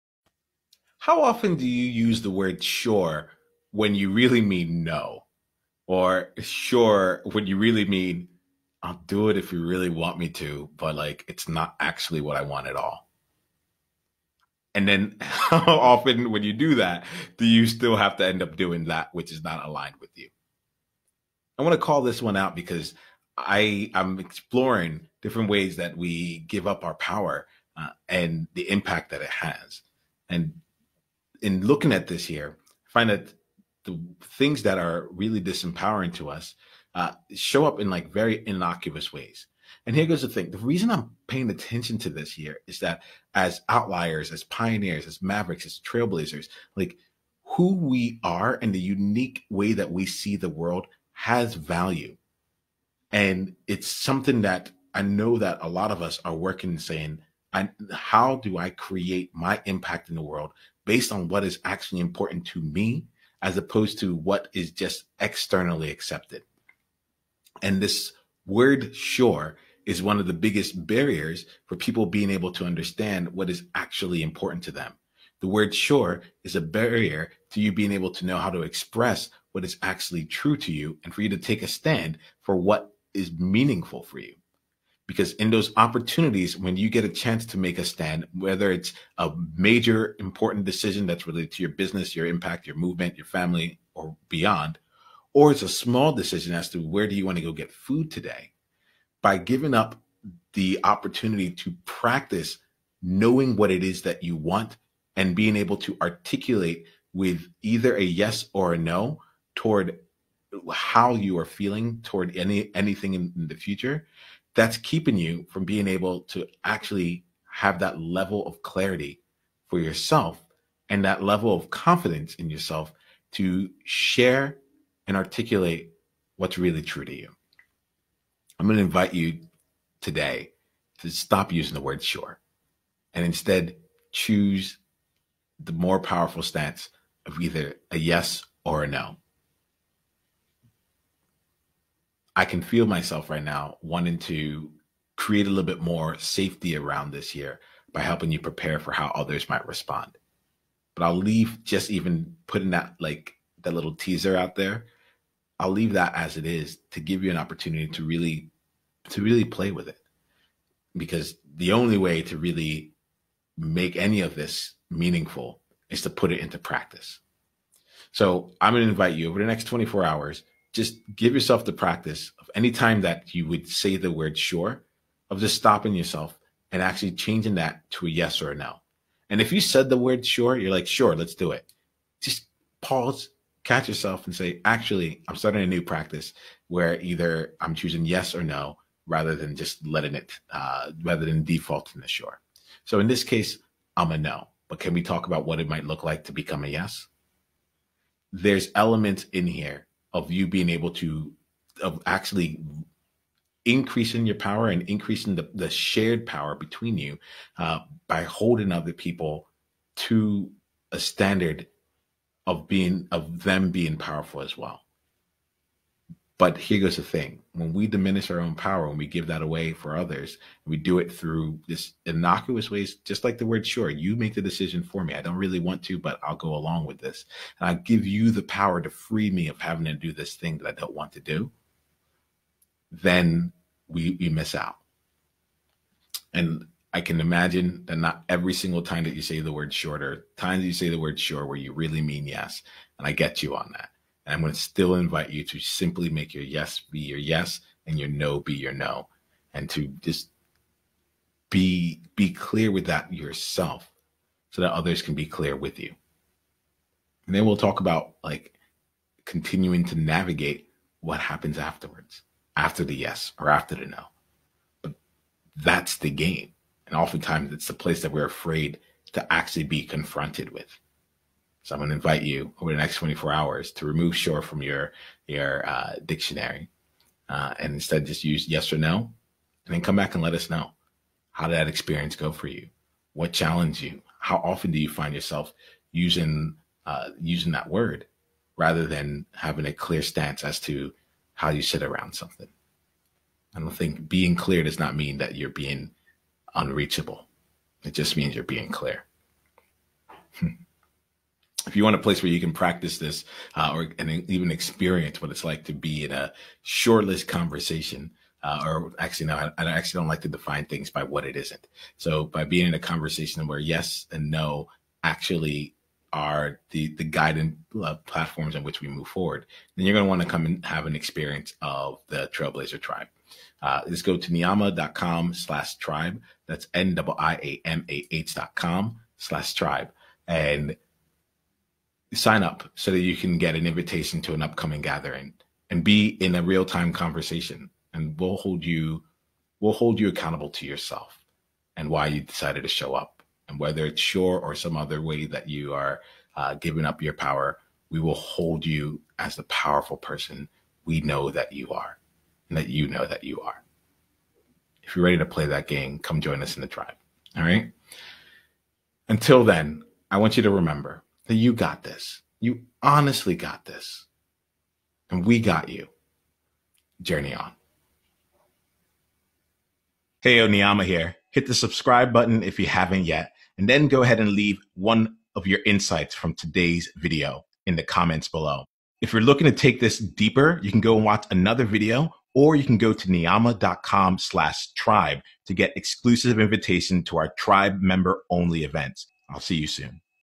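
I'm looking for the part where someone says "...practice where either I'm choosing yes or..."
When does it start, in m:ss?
3:05.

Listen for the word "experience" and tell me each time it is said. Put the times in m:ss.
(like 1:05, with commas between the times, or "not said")
4:41, 5:04, 5:20.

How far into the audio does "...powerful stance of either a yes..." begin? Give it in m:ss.
2:15.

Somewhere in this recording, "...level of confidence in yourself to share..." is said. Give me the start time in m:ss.
2:01.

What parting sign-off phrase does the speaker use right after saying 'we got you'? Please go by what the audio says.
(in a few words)
Journey on.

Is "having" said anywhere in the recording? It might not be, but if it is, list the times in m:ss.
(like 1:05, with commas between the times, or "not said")
3:49, 4:49.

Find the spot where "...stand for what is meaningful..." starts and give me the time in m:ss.
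1:21.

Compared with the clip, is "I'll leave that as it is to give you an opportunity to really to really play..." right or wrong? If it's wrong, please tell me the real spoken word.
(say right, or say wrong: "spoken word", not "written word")
right.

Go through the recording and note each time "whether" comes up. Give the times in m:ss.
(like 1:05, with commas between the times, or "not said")
1:28, 5:43.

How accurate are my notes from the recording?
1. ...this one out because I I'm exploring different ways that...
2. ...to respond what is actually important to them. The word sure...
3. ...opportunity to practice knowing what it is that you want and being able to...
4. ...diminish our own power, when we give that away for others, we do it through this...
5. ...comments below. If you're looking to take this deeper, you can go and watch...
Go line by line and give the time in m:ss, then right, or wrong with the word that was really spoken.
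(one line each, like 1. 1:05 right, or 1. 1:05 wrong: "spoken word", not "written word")
1. 0:22 right
2. 1:12 wrong: "understand", not "respond"
3. 1:40 right
4. 3:37 right
5. 6:17 right.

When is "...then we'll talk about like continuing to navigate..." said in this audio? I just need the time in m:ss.
4:17.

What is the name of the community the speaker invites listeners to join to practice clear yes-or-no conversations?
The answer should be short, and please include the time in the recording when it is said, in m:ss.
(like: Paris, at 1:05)
trailblazer tribe, at 5:22.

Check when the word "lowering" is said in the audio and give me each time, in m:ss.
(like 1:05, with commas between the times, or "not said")
not said.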